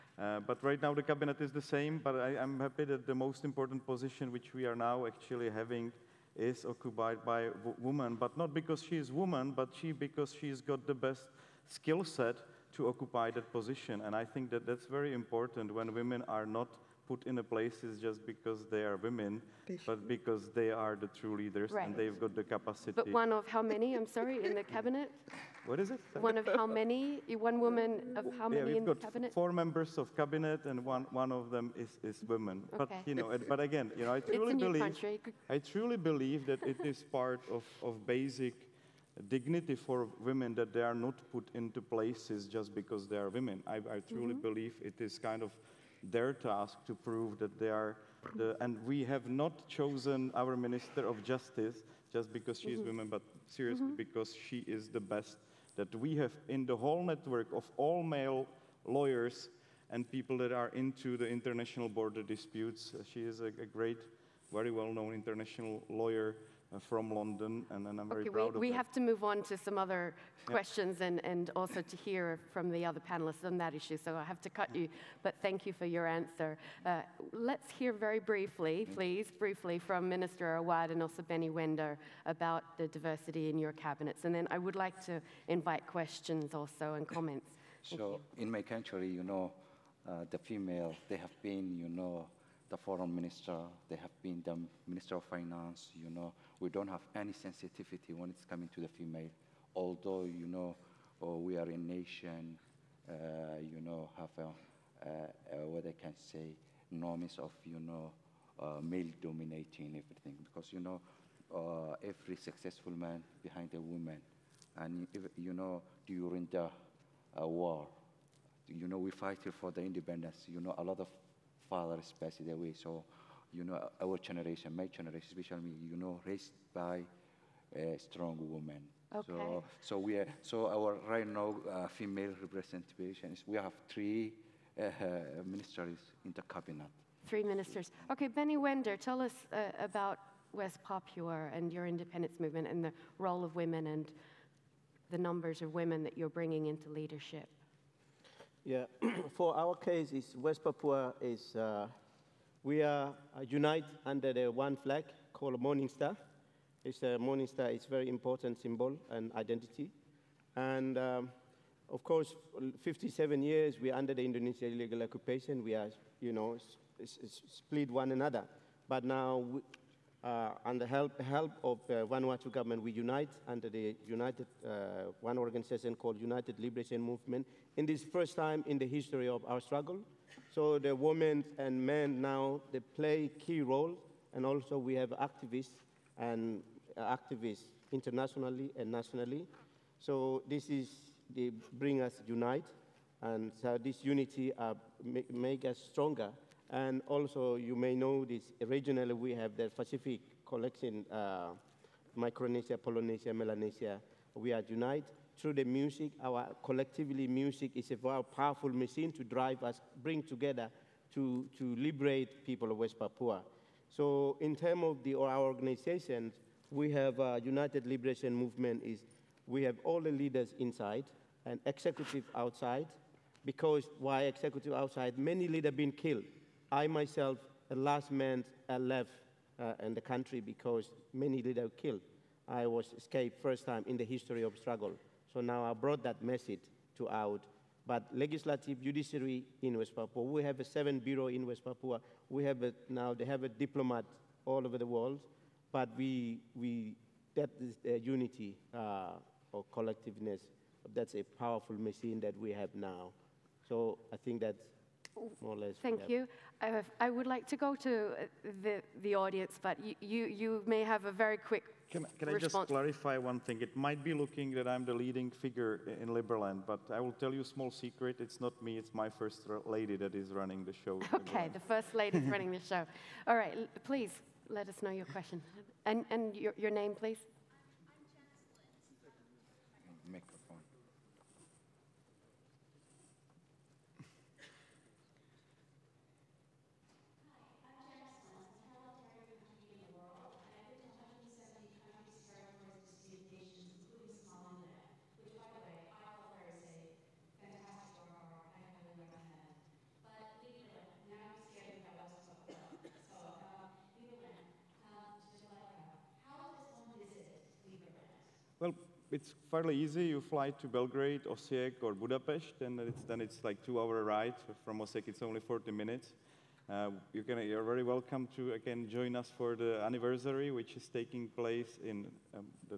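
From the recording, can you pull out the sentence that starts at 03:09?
So this is, they bring us unite, and so this unity uh, make, make us stronger.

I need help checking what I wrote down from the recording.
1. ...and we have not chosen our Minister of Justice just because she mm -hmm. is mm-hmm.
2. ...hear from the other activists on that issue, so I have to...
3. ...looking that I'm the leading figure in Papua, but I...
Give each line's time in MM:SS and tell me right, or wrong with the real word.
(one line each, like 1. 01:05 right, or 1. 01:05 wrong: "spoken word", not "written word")
1. 00:48 right
2. 01:11 wrong: "panelists", not "activists"
3. 04:24 wrong: "Liberland", not "Papua".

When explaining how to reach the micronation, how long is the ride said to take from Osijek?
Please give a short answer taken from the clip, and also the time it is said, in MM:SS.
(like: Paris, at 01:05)
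40 minutes, at 05:15.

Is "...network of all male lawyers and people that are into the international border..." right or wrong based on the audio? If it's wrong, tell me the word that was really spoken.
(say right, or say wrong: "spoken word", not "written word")
right.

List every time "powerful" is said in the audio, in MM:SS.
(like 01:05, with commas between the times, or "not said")
03:28, 04:11.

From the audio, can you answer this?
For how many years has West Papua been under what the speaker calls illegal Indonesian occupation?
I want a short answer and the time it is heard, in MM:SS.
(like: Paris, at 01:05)
57, at 02:42.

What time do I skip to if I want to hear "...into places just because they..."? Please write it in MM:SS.
00:41.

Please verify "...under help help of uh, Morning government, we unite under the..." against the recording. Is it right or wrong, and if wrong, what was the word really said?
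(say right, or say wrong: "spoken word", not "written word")
wrong: "Vanuatu", not "Morning".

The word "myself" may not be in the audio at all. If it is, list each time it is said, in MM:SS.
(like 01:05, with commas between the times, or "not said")
03:46.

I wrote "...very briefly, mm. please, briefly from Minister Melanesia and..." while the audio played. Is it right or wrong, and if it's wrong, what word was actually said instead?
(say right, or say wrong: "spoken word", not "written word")
wrong: "Awad", not "Melanesia".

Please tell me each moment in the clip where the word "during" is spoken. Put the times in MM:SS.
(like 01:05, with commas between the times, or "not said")
01:56.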